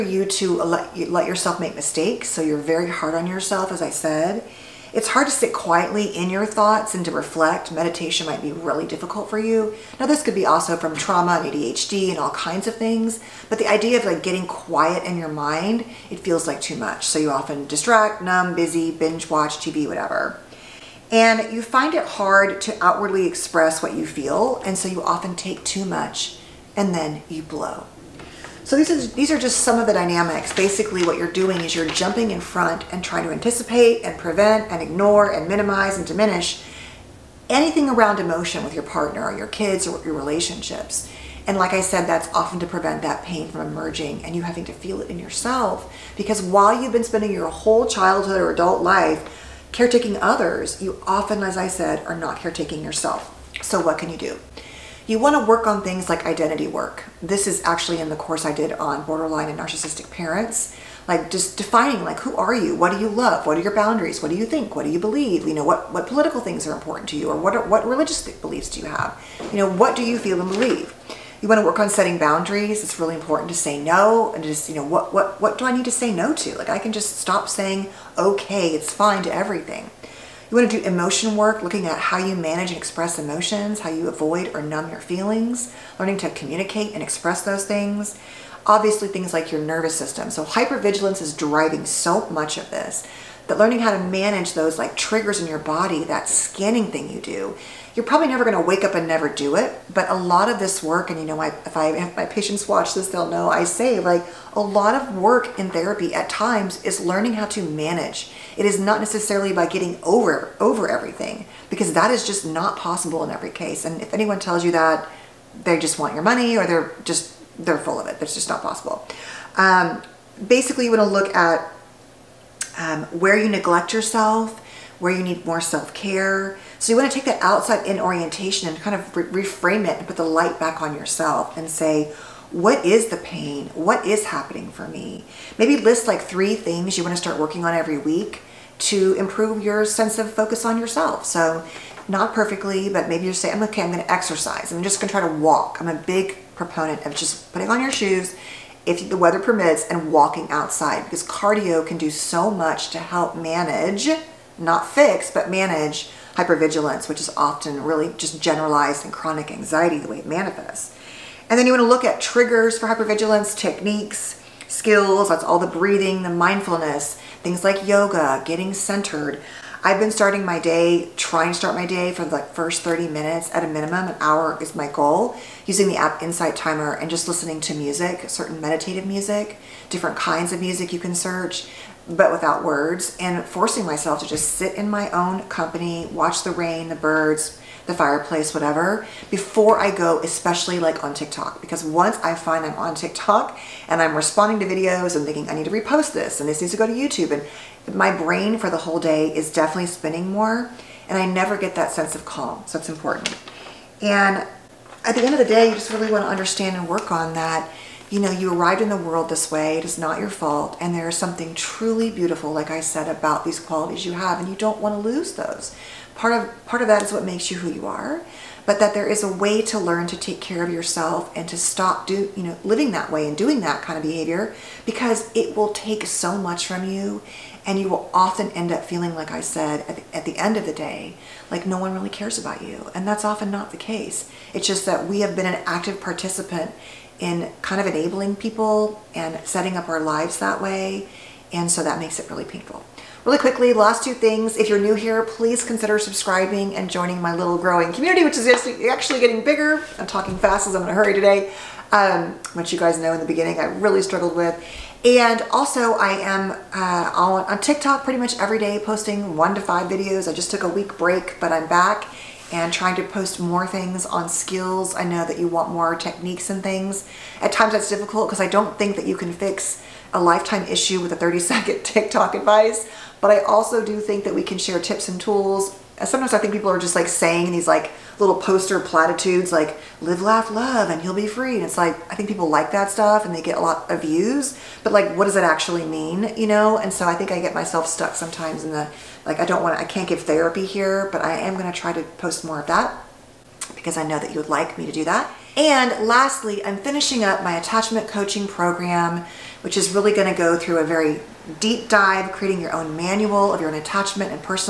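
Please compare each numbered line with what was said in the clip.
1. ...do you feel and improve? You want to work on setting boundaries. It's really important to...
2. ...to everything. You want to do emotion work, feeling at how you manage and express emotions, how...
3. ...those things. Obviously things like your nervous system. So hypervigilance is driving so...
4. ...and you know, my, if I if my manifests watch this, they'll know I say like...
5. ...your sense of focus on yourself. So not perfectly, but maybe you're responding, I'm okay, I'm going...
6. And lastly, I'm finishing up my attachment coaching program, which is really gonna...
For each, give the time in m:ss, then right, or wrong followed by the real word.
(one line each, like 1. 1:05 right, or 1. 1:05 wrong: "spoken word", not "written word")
1. 1:09 wrong: "believe", not "improve"
2. 1:19 wrong: "looking", not "feeling"
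3. 1:27 right
4. 1:41 wrong: "patients", not "manifests"
5. 2:19 wrong: "saying", not "responding"
6. 4:55 right.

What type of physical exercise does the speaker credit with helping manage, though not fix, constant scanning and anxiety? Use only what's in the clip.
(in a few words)
cardio.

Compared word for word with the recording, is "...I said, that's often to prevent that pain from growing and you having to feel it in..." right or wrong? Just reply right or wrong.
wrong.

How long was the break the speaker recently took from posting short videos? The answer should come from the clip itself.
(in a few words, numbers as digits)
a week.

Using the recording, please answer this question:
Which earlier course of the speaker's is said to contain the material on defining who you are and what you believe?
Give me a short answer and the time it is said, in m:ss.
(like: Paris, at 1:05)
borderline and narcissistic parents, at 0:59.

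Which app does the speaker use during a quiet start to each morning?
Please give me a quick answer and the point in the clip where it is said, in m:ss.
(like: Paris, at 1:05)
Insight Timer, at 2:56.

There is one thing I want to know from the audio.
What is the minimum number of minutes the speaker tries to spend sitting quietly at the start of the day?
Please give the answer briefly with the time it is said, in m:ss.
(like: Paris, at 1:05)
30, at 2:52.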